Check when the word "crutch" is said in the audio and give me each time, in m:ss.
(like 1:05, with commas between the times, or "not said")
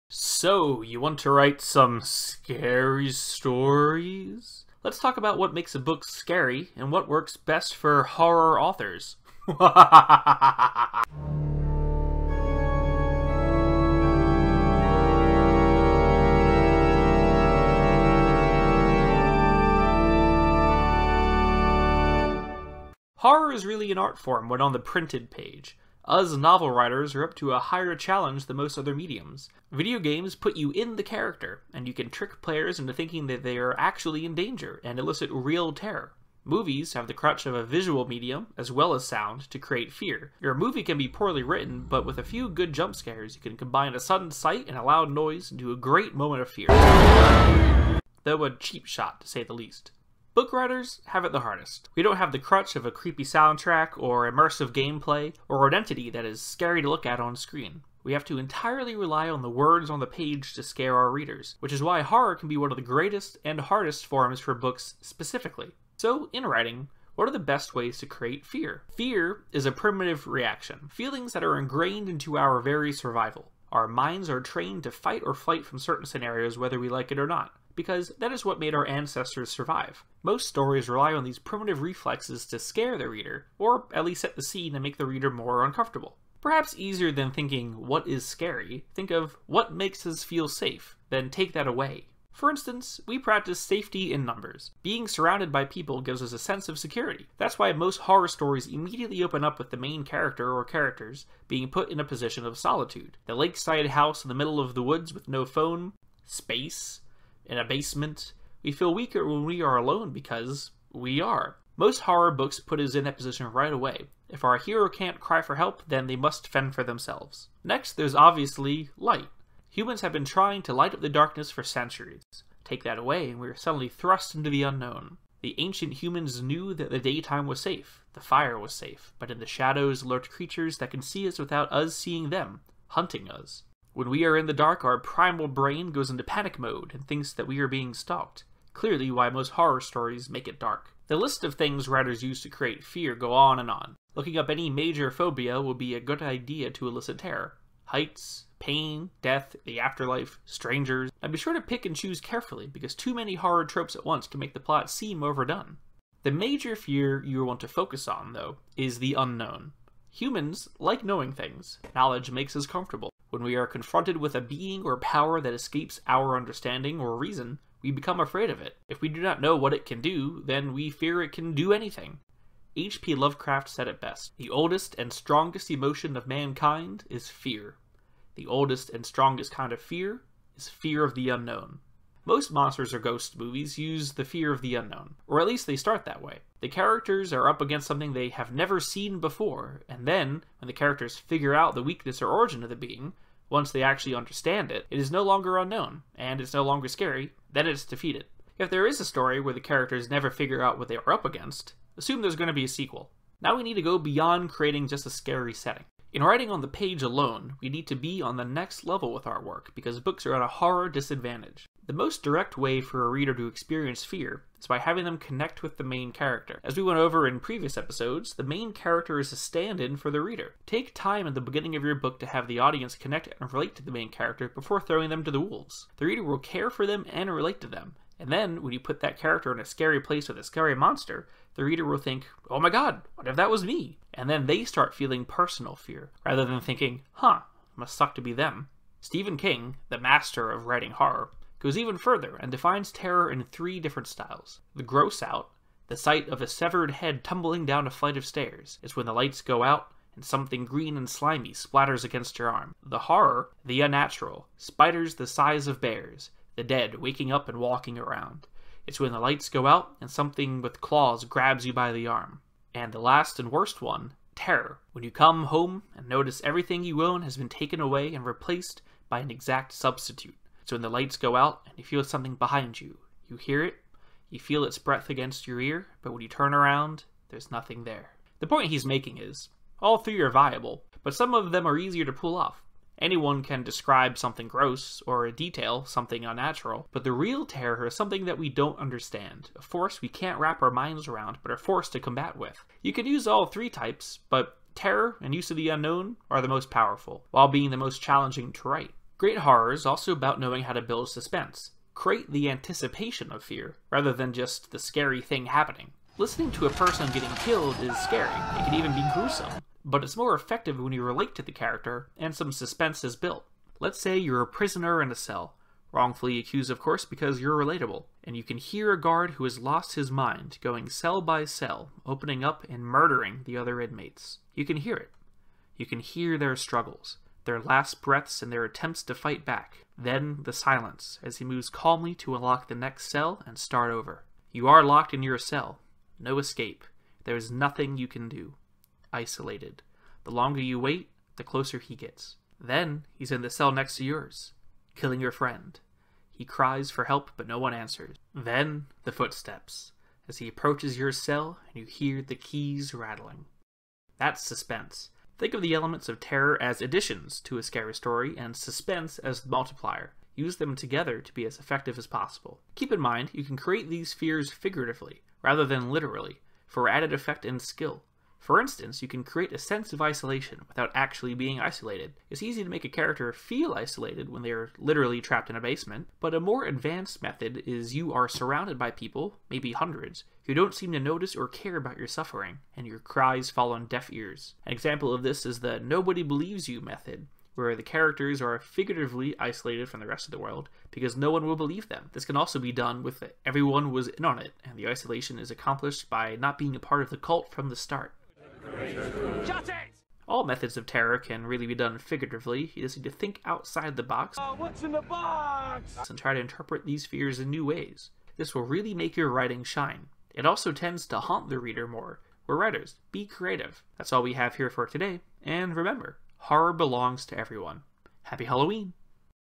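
0:37, 0:52.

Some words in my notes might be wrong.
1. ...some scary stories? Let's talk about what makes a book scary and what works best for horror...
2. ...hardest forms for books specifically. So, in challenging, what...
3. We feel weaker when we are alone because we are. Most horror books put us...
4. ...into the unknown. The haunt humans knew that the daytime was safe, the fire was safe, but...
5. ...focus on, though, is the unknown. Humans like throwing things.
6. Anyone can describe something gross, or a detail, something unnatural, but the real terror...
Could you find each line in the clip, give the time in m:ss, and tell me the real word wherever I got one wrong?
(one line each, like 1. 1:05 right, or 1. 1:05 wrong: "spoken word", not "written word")
1. 0:01 right
2. 1:03 wrong: "writing", not "challenging"
3. 1:48 right
4. 2:04 wrong: "ancient", not "haunt"
5. 2:37 wrong: "knowing", not "throwing"
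6. 4:42 right.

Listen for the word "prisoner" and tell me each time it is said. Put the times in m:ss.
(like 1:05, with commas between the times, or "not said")
5:14.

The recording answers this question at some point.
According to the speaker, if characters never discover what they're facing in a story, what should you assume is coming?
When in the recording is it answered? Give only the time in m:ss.
3:22.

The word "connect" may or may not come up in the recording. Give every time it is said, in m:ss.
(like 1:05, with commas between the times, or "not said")
3:35, 3:42.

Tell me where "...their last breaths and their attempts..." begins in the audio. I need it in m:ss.
5:27.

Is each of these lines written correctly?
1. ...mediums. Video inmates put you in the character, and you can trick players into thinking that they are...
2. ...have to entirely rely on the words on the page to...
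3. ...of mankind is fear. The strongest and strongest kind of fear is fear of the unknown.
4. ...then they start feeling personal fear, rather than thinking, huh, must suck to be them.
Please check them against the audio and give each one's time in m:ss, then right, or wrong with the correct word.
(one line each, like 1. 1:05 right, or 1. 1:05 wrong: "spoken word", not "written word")
1. 0:28 wrong: "games", not "inmates"
2. 0:58 right
3. 2:56 wrong: "oldest", not "strongest"
4. 3:54 right.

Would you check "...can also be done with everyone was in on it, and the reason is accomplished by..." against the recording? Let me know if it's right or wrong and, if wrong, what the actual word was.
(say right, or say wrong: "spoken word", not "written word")
wrong: "isolation", not "reason".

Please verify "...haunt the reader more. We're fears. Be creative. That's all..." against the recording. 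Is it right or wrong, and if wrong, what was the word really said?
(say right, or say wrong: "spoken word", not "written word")
wrong: "writers", not "fears".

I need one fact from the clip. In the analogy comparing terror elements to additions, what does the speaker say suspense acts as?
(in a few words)
The multiplier.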